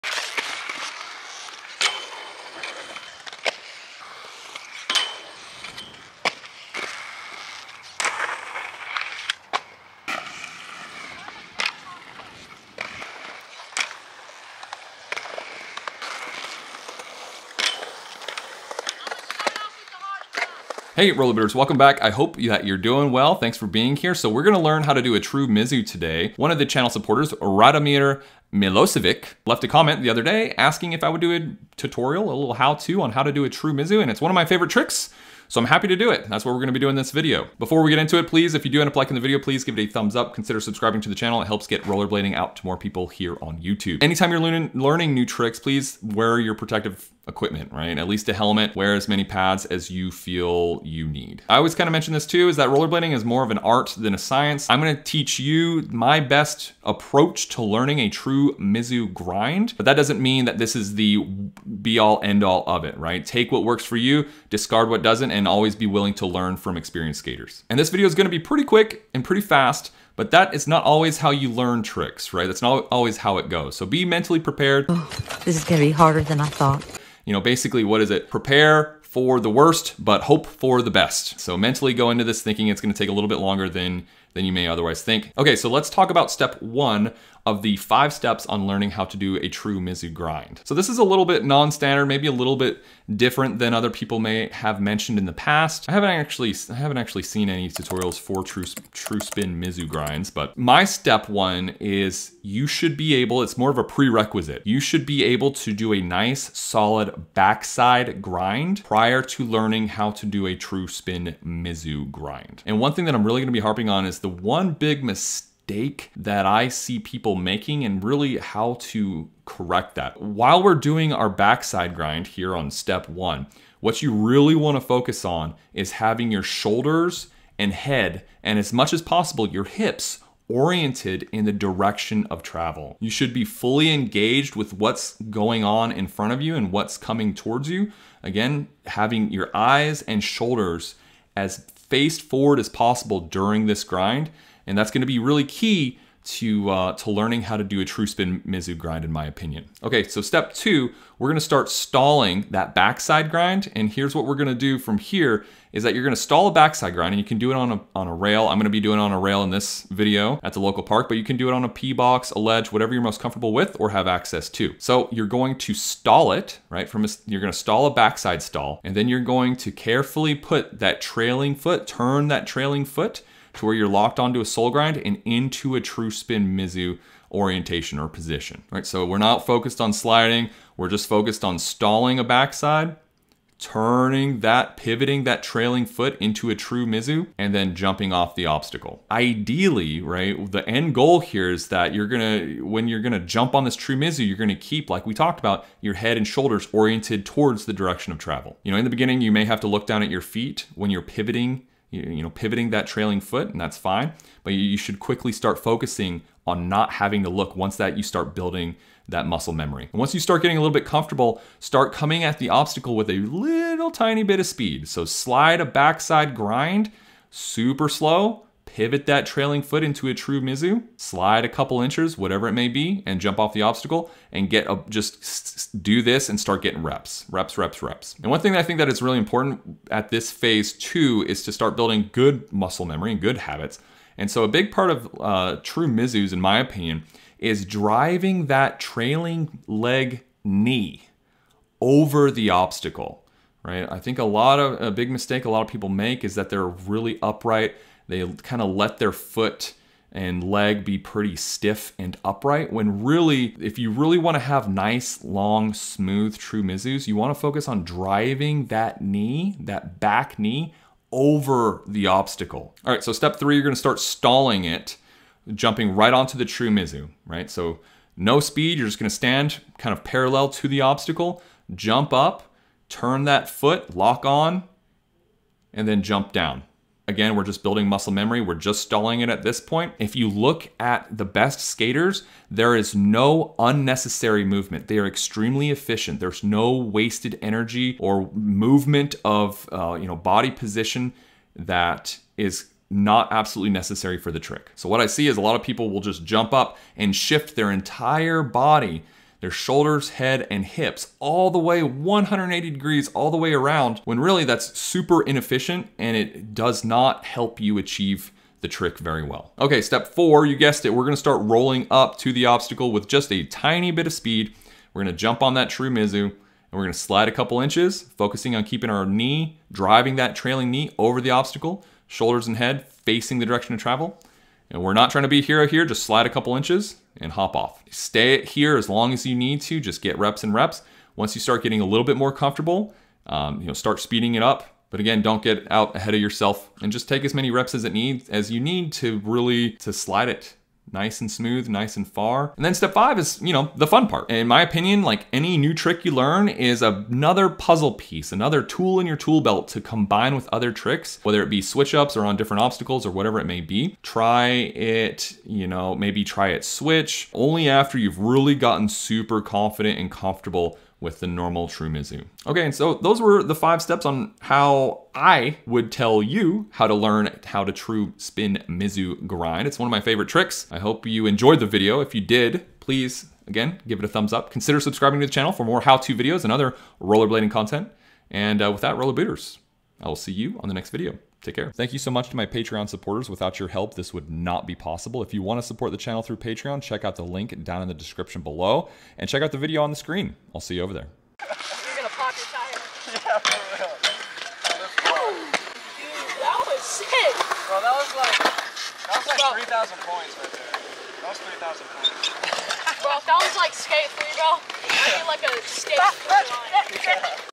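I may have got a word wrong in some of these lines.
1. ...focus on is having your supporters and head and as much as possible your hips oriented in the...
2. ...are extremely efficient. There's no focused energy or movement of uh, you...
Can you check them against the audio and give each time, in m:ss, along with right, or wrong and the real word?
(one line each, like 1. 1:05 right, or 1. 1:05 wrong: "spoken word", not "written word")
1. 2:04 wrong: "shoulders", not "supporters"
2. 4:44 wrong: "wasted", not "focused".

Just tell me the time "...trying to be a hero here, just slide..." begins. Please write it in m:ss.
5:25.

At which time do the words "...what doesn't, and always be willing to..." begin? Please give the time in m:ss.
1:04.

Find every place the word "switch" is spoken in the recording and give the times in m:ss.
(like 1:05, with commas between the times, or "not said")
5:51, 5:56.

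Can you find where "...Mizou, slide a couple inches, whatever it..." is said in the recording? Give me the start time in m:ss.
3:40.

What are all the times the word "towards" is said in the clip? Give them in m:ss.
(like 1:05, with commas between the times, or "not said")
2:17, 3:17.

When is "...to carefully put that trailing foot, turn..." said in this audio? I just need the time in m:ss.
2:49.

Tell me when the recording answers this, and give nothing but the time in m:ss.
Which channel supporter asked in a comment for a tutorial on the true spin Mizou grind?
0:27.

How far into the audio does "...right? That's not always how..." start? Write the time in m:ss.
1:12.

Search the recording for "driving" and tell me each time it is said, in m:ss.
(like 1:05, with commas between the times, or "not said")
3:57, 4:17, 5:19.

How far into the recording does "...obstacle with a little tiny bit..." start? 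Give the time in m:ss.
3:32.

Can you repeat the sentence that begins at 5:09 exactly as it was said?
Okay, step four, you guessed it, we're gonna start rolling up to the obstacle with just a tiny bit of speed.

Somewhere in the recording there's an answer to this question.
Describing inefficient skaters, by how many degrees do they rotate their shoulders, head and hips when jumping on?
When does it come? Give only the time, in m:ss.
5:01.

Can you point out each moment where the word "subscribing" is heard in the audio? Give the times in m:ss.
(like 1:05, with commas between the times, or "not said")
0:40, 6:14.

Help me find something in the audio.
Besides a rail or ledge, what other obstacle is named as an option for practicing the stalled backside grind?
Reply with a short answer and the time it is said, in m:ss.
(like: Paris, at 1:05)
P box, at 2:41.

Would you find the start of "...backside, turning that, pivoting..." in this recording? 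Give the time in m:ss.
3:02.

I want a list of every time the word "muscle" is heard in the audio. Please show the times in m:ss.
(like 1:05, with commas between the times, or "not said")
3:29, 3:52, 4:37.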